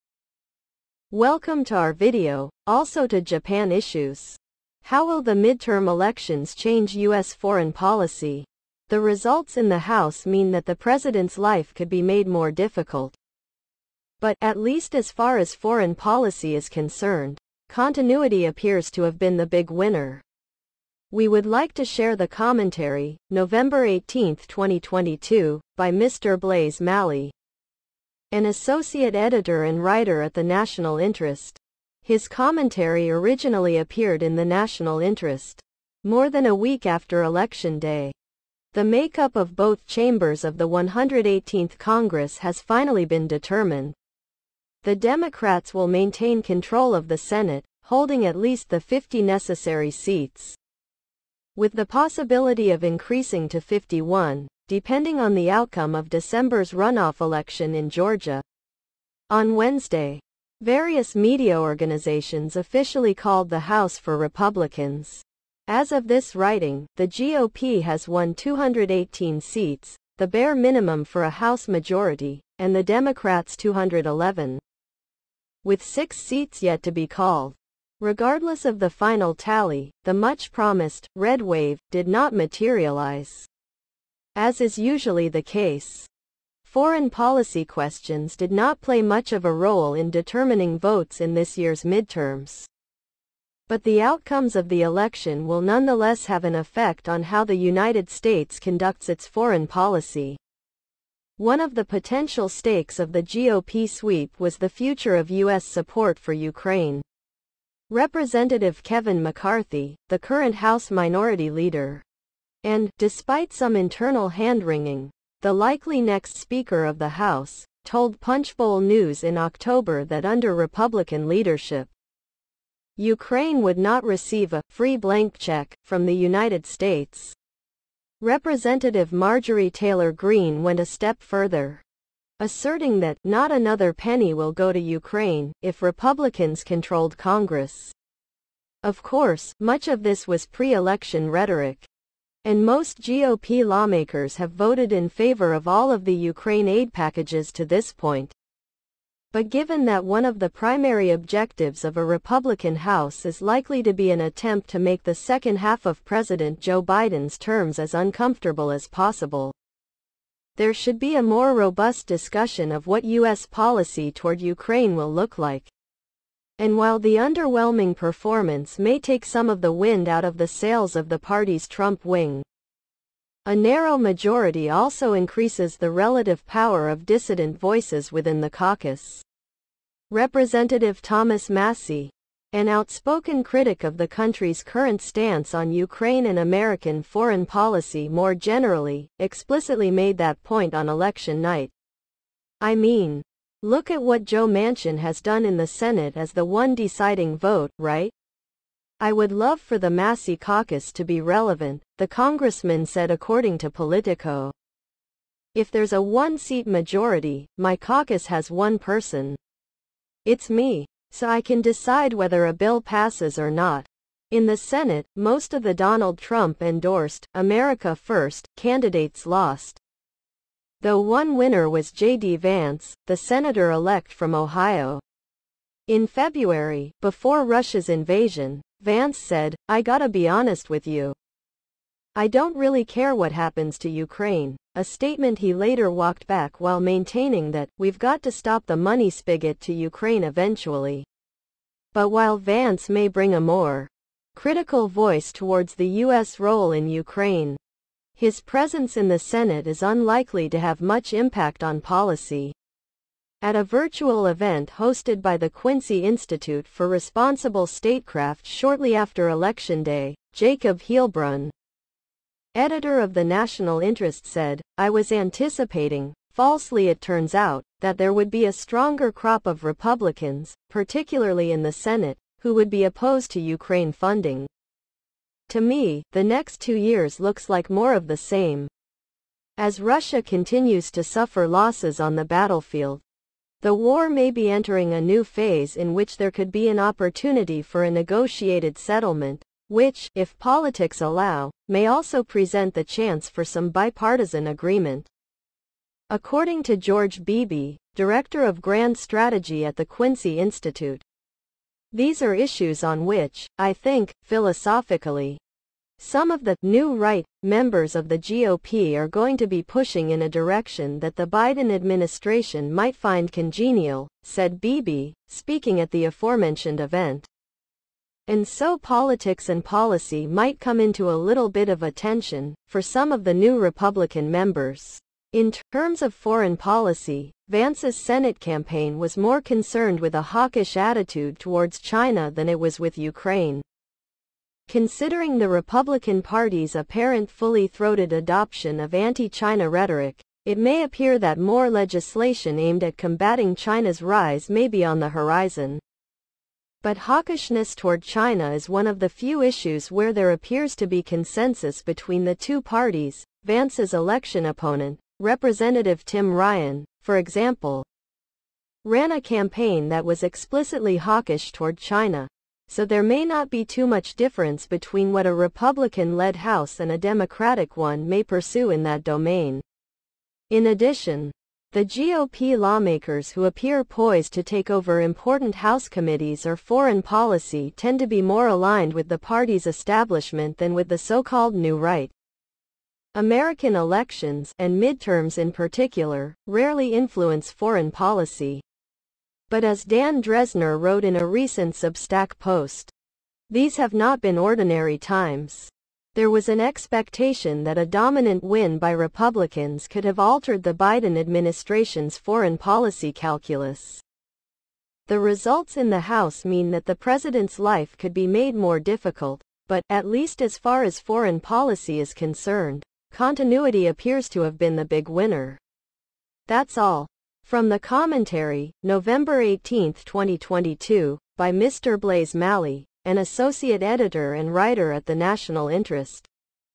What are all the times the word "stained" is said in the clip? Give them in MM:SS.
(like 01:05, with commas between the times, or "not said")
not said.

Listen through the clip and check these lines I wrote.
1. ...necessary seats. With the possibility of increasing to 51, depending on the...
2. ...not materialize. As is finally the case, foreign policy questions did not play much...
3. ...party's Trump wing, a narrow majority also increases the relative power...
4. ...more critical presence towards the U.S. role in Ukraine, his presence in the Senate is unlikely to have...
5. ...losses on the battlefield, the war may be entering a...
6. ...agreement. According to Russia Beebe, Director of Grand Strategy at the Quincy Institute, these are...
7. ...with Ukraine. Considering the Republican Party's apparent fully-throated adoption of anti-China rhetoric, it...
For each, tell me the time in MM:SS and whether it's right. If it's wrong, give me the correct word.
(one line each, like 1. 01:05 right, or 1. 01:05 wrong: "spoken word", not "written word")
1. 00:49 right
2. 01:22 wrong: "usually", not "finally"
3. 02:51 right
4. 04:03 wrong: "voice", not "presence"
5. 04:41 right
6. 04:54 wrong: "George", not "Russia"
7. 05:32 right.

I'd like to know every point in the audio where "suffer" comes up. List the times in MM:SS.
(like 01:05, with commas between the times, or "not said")
04:41.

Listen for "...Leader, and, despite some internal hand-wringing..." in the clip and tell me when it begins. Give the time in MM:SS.
01:51.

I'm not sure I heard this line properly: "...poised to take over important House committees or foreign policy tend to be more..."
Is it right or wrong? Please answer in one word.
right.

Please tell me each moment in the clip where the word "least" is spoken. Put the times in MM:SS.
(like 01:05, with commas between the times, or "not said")
00:14, 00:48, 06:50.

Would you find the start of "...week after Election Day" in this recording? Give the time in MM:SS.
00:36.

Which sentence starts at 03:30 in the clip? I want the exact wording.
It's me, so I can decide whether a bill passes or not.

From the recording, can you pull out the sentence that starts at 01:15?
With six seats yet to be called.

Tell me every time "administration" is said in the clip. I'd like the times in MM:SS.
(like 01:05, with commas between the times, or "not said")
05:11, 06:41.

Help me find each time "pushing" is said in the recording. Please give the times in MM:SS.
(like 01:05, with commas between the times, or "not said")
05:09.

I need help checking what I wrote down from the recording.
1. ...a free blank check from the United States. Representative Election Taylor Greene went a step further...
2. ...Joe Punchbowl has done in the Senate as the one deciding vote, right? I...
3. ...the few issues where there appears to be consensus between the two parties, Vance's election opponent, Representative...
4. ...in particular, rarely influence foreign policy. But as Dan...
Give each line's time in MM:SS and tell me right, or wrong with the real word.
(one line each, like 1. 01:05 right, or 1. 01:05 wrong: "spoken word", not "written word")
1. 02:04 wrong: "Marjorie", not "Election"
2. 03:14 wrong: "Manchin", not "Punchbowl"
3. 05:48 right
4. 06:25 right.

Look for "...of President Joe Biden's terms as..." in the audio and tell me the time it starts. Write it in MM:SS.
02:35.